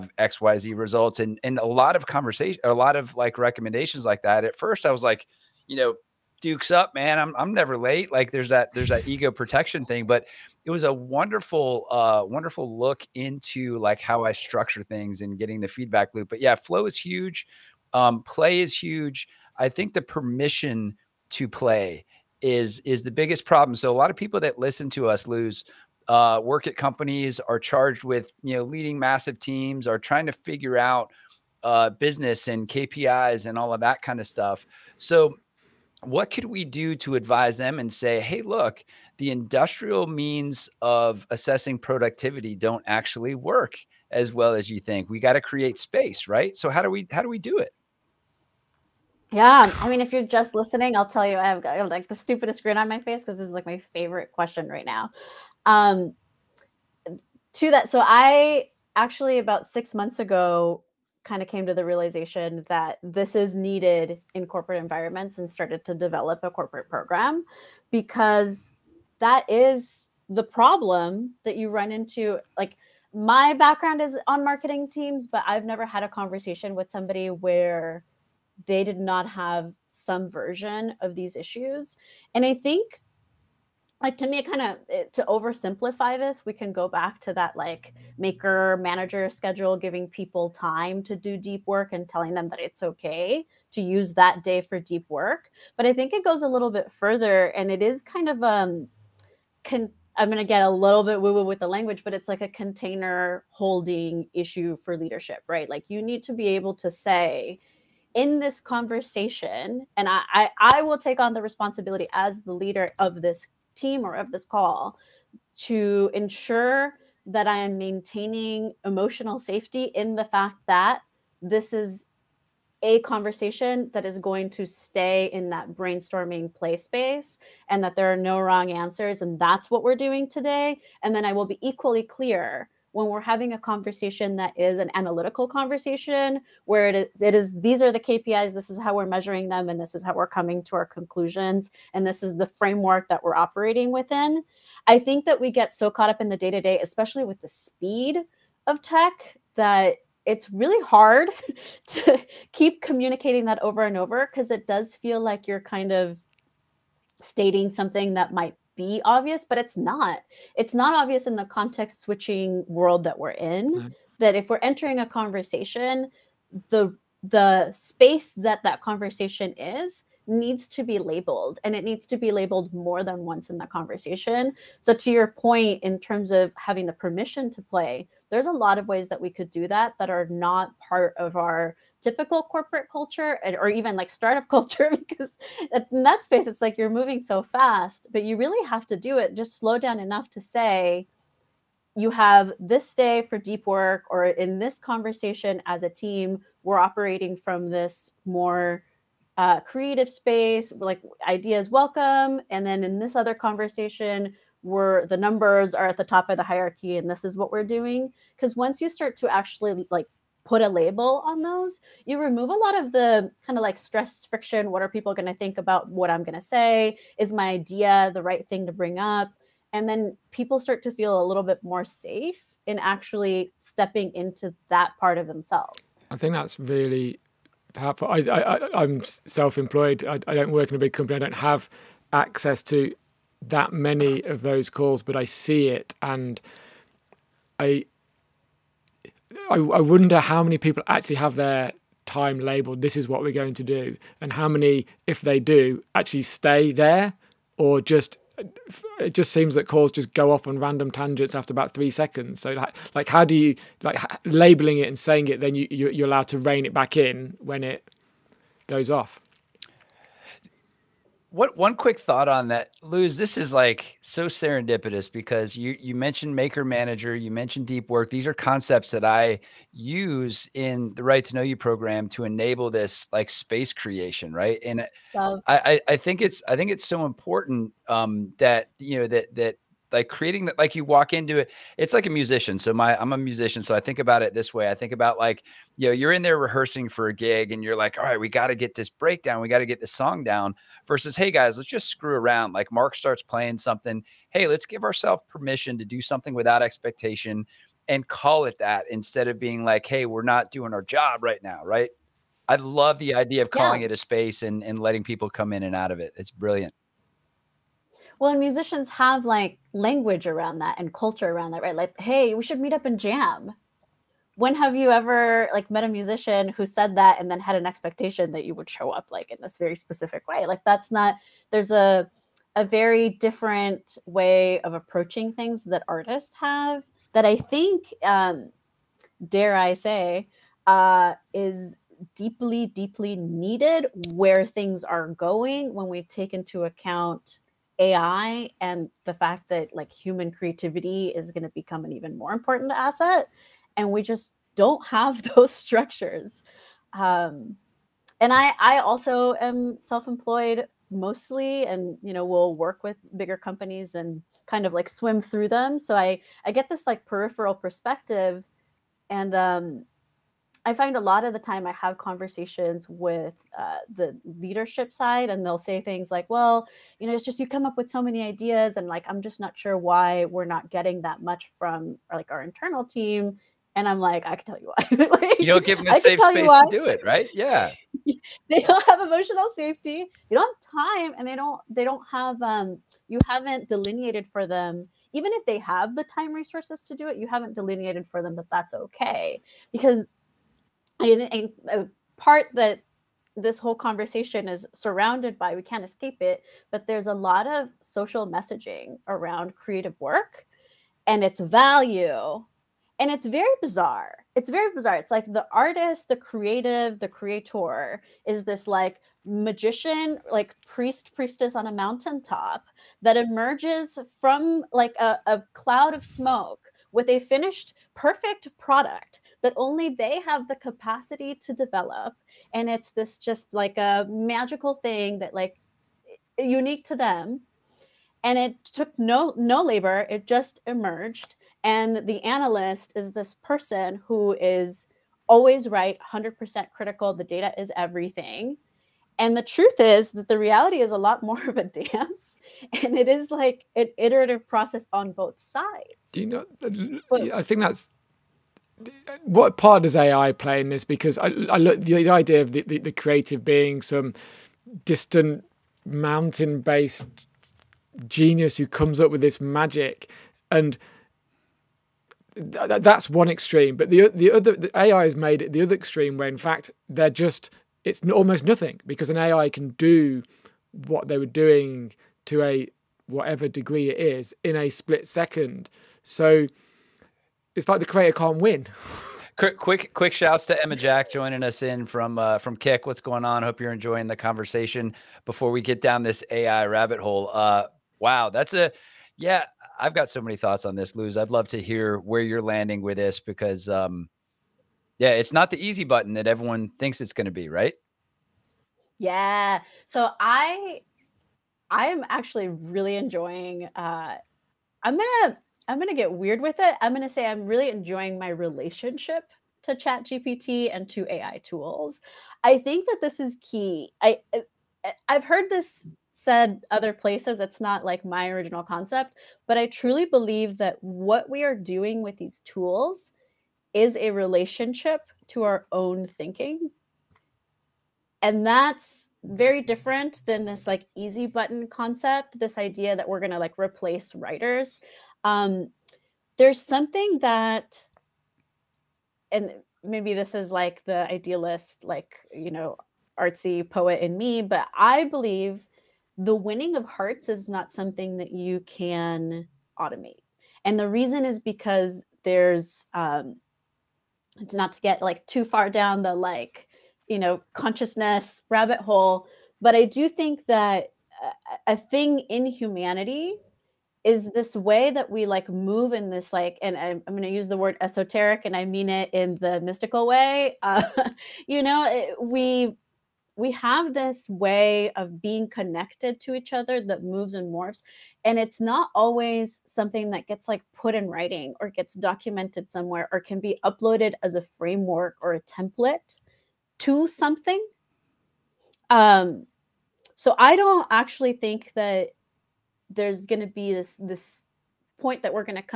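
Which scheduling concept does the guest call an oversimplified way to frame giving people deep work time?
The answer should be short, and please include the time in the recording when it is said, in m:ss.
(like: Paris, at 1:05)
Maker manager schedule, at 1:28.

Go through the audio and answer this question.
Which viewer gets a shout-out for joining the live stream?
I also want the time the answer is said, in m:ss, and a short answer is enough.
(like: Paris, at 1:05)
Emma Jack, at 8:00.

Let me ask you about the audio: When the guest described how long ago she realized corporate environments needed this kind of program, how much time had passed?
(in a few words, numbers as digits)
6 months.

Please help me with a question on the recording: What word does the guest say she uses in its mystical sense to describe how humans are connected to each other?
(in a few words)
Esoteric.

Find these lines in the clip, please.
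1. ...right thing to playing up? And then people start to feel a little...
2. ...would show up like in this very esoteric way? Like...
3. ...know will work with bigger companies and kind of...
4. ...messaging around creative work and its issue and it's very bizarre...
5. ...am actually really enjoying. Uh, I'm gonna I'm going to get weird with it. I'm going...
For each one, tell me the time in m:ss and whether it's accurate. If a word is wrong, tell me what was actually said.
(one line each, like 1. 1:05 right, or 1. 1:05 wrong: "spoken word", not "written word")
1. 3:38 wrong: "bring", not "playing"
2. 5:18 wrong: "specific", not "esoteric"
3. 5:52 right
4. 6:38 wrong: "value", not "issue"
5. 8:21 right.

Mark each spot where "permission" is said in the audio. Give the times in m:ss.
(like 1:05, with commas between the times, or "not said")
0:20, 2:56, 4:55.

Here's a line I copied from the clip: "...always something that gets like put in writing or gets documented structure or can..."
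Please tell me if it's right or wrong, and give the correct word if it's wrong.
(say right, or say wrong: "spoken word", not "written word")
wrong: "somewhere", not "structure".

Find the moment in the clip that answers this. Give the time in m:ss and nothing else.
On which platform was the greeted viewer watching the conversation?
8:02.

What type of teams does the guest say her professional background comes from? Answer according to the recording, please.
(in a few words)
Marketing teams.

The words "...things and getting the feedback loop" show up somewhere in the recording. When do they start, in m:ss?
0:14.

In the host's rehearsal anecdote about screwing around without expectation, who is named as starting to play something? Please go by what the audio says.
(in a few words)
Mark.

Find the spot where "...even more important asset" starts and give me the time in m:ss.
5:41.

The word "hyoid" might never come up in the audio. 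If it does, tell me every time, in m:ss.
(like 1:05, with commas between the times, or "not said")
not said.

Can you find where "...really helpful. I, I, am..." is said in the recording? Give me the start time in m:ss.
3:46.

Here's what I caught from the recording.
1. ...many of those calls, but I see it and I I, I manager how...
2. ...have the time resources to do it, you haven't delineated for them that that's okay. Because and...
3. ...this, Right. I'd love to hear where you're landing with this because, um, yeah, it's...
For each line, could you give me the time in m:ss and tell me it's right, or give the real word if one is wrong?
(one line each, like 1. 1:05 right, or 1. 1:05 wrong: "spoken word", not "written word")
1. 3:53 wrong: "wonder", not "manager"
2. 6:25 right
3. 8:10 wrong: "Luz", not "Right".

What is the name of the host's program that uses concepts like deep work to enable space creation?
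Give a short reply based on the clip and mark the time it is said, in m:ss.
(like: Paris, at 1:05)
Right to Know You, at 4:31.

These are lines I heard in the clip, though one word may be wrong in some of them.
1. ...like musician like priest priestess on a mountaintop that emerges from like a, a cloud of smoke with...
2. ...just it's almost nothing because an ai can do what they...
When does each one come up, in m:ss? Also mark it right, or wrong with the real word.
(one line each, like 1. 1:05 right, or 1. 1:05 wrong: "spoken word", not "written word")
1. 6:48 wrong: "magician", not "musician"
2. 7:47 right.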